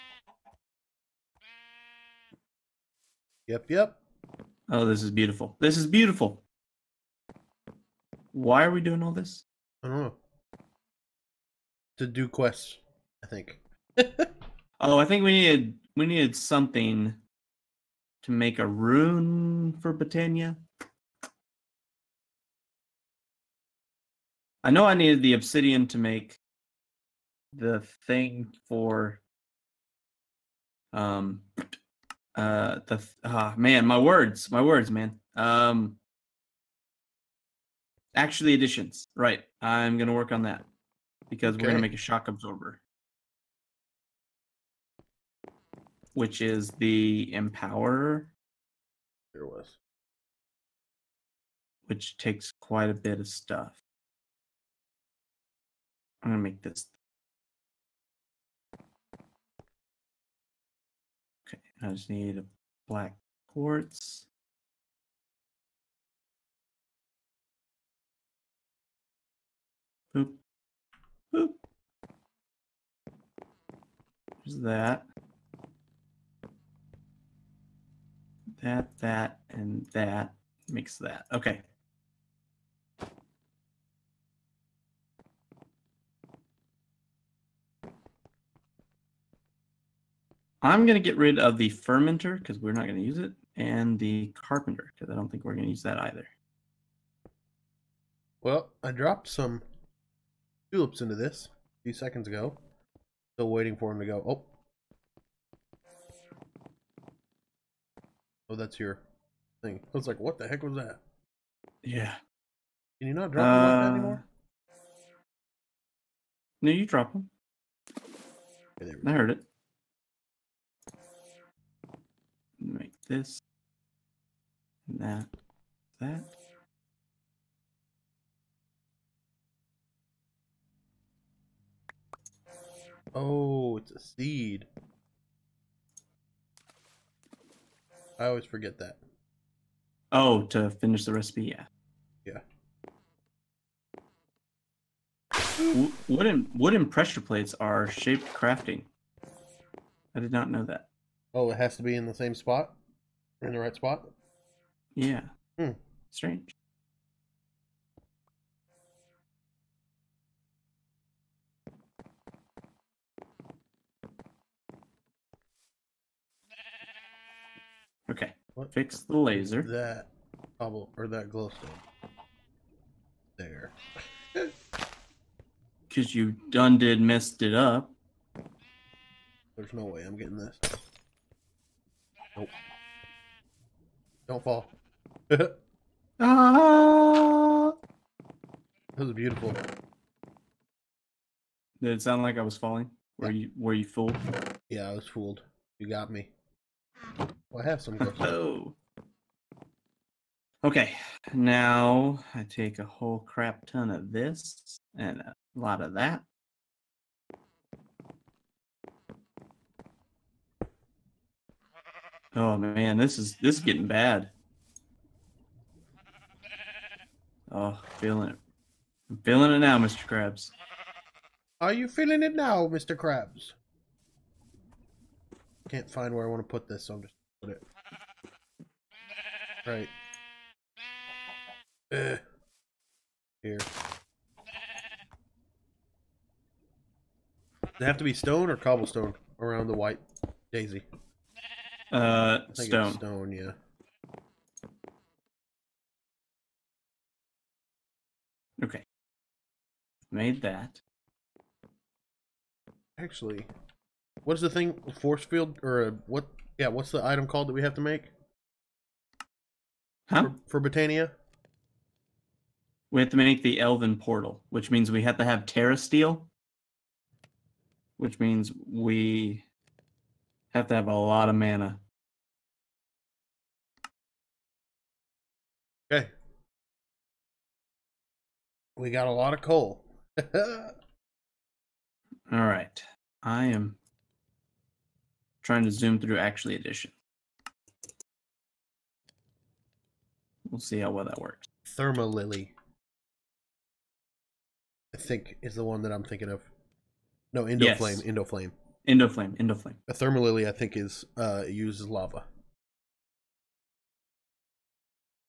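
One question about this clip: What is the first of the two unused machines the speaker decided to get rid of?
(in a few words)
fermenter.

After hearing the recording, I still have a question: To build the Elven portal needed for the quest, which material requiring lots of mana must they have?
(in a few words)
Terrasteel.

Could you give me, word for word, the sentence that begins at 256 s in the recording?
Yeah, what's the item called that we have to make?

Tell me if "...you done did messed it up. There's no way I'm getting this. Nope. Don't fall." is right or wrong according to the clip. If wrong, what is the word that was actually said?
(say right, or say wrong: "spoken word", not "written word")
right.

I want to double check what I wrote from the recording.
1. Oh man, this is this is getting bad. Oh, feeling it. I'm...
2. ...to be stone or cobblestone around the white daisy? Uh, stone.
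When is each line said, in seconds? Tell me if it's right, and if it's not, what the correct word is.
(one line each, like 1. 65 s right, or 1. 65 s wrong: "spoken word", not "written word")
1. 212 s right
2. 237 s right.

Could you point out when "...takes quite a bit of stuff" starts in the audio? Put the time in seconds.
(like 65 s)
52 s.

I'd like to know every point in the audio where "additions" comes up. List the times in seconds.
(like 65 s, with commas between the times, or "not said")
38 s, 286 s.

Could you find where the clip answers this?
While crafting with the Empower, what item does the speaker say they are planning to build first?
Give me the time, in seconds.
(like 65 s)
41 s.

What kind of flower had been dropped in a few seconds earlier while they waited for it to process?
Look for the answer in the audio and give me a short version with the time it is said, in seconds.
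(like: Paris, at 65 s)
tulips, at 100 s.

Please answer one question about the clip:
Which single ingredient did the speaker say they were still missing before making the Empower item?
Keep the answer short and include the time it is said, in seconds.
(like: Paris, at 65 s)
black quartz, at 62 s.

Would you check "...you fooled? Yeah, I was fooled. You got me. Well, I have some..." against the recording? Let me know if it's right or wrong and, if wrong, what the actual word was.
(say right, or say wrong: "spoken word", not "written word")
right.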